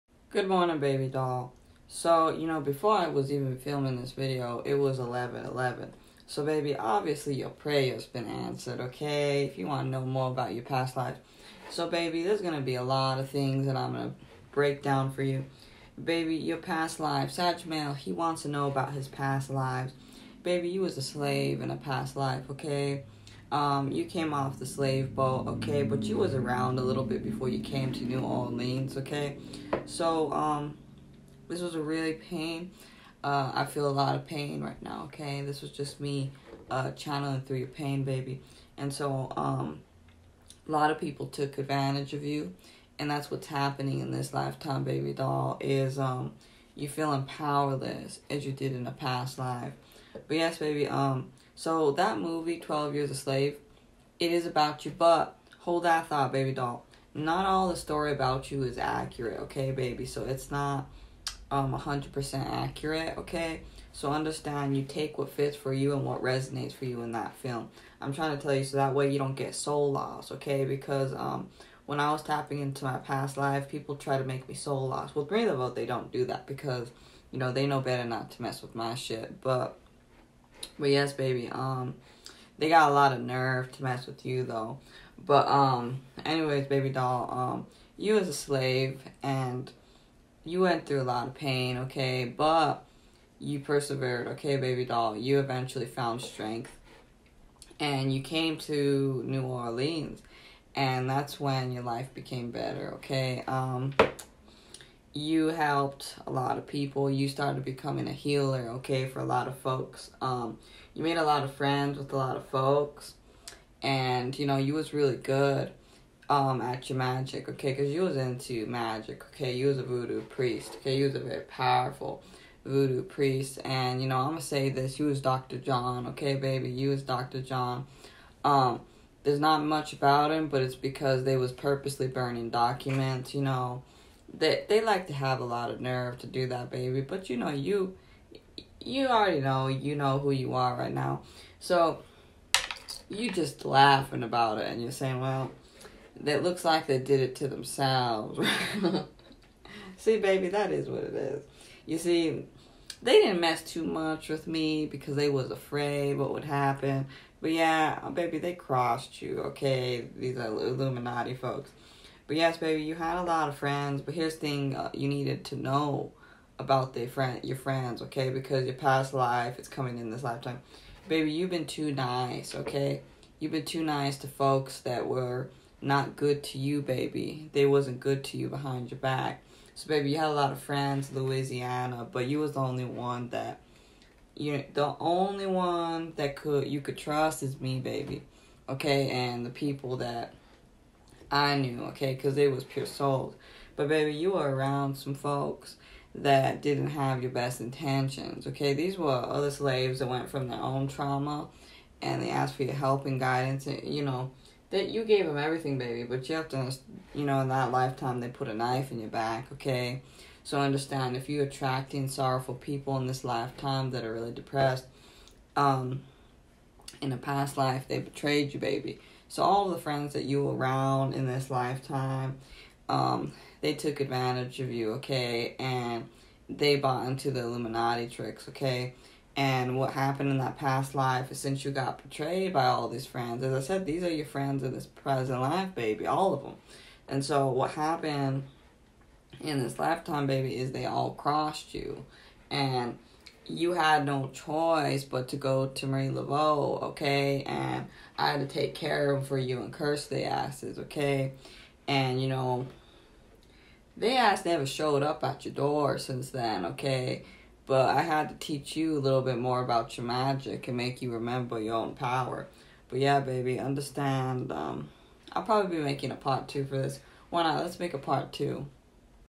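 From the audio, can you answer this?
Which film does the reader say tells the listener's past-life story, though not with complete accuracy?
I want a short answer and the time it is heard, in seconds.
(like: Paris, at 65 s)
Twelve Years a Slave, at 52 s.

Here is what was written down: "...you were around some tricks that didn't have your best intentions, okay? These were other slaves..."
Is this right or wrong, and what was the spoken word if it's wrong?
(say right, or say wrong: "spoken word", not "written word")
wrong: "folks", not "tricks".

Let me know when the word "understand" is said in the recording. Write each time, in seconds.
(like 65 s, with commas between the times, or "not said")
64 s, 210 s, 263 s.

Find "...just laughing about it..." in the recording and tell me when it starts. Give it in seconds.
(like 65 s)
143 s.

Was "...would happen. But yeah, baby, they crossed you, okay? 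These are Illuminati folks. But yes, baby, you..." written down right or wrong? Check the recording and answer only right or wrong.
right.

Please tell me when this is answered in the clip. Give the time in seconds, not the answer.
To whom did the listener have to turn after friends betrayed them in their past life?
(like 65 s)
245 s.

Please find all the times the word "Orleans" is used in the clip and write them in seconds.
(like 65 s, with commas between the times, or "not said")
28 s, 99 s.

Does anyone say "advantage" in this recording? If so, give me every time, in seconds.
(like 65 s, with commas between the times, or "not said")
41 s, 224 s.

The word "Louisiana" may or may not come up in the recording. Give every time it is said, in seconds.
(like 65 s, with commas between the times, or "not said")
181 s.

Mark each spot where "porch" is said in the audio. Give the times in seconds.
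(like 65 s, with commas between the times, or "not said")
not said.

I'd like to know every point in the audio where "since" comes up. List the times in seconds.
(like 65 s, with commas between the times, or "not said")
231 s, 255 s.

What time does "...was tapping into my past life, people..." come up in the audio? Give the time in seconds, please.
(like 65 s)
72 s.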